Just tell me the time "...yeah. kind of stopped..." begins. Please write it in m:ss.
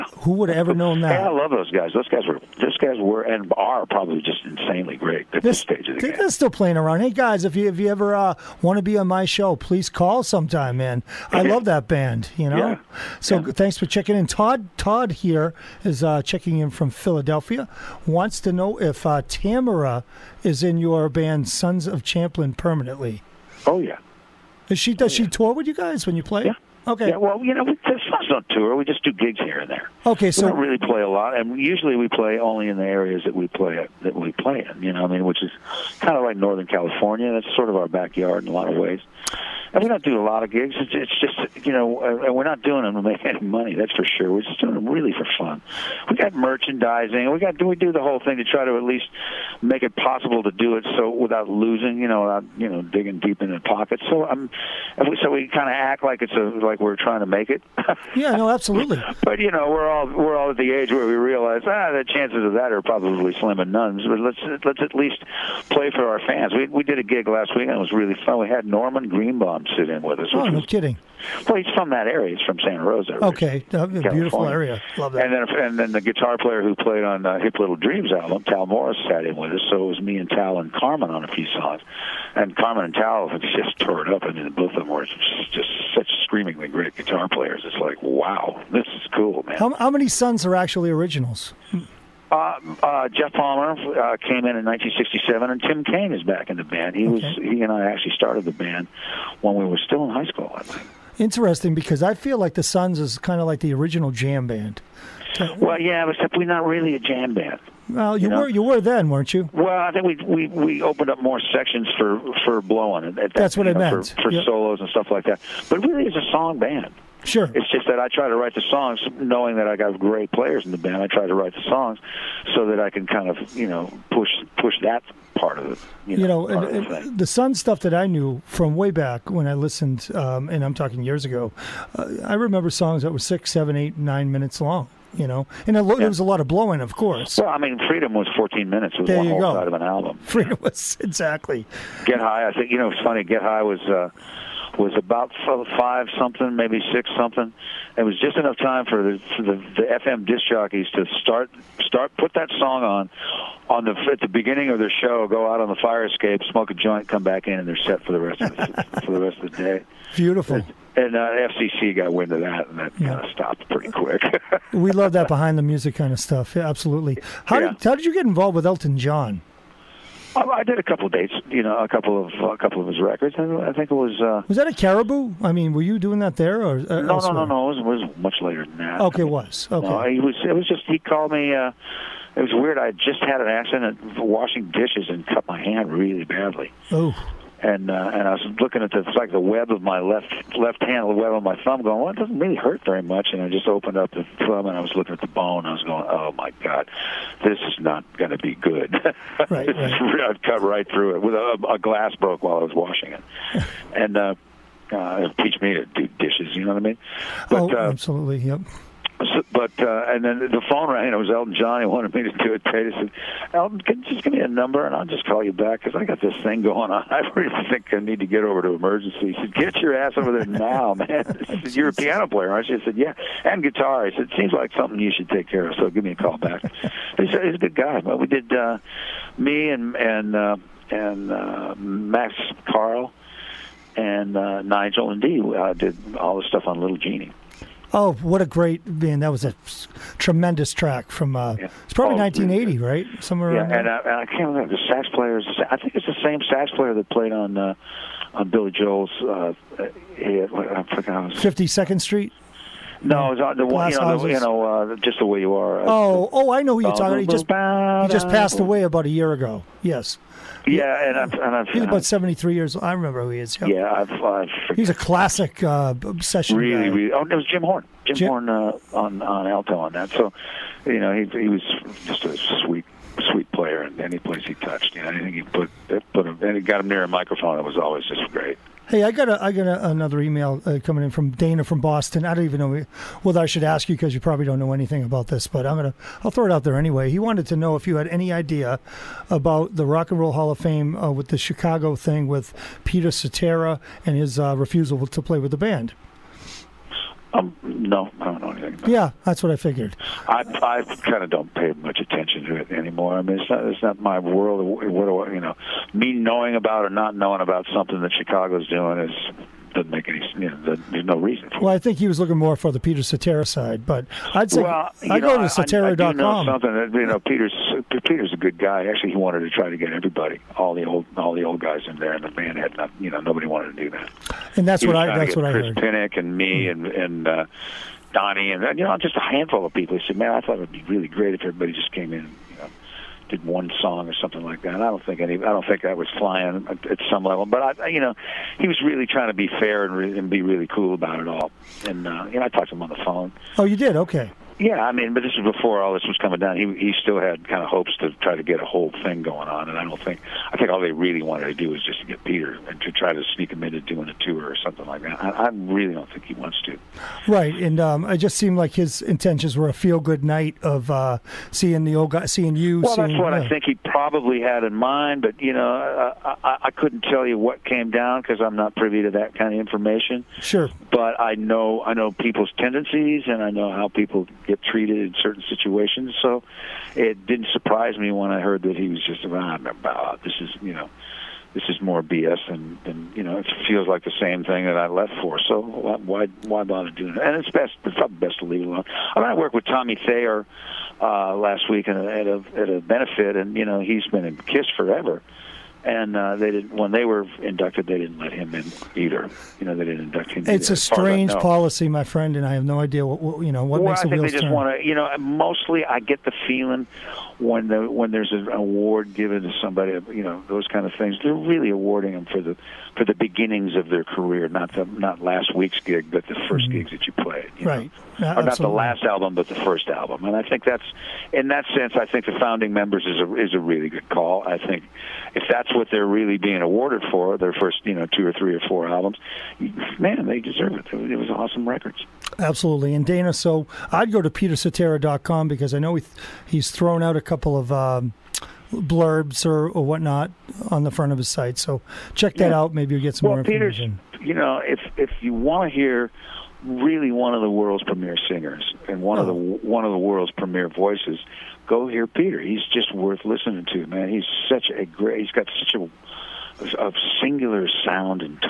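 2:42.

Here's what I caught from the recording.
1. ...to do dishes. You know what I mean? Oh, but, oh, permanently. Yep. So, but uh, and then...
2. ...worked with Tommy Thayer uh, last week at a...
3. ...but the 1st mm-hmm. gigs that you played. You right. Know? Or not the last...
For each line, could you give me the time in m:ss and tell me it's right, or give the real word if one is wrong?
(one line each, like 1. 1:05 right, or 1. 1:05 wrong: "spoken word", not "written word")
1. 3:25 wrong: "absolutely", not "permanently"
2. 6:29 right
3. 6:56 right.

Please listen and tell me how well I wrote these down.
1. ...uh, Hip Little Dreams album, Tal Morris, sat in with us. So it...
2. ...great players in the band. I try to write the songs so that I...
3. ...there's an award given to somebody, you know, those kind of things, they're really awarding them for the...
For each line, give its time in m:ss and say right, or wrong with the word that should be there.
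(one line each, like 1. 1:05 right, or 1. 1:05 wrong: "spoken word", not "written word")
1. 1:17 right
2. 1:59 right
3. 6:48 right.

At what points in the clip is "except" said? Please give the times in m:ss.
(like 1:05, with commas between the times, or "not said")
1:46.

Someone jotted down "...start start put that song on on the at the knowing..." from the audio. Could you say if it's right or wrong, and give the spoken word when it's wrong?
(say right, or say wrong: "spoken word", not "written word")
wrong: "beginning", not "knowing".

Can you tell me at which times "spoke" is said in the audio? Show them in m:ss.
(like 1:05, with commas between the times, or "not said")
not said.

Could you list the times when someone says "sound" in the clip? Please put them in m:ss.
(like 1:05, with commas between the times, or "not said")
7:37.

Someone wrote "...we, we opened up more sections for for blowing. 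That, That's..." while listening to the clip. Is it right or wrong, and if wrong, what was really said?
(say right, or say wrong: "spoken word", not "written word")
right.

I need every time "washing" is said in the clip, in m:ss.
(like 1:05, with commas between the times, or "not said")
3:04, 3:22.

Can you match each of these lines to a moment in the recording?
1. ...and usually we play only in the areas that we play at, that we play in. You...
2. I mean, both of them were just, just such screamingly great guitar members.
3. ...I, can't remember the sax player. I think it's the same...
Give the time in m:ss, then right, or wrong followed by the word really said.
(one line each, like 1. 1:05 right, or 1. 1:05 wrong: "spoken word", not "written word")
1. 0:31 right
2. 1:24 wrong: "players", not "members"
3. 4:04 right.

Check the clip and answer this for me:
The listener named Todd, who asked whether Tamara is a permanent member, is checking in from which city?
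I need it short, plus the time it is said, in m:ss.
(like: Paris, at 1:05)
Philadelphia, at 0:16.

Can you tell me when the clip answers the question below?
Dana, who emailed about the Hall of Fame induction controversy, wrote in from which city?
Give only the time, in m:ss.
4:41.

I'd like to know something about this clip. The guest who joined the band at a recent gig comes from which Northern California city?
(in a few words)
Santa Rosa.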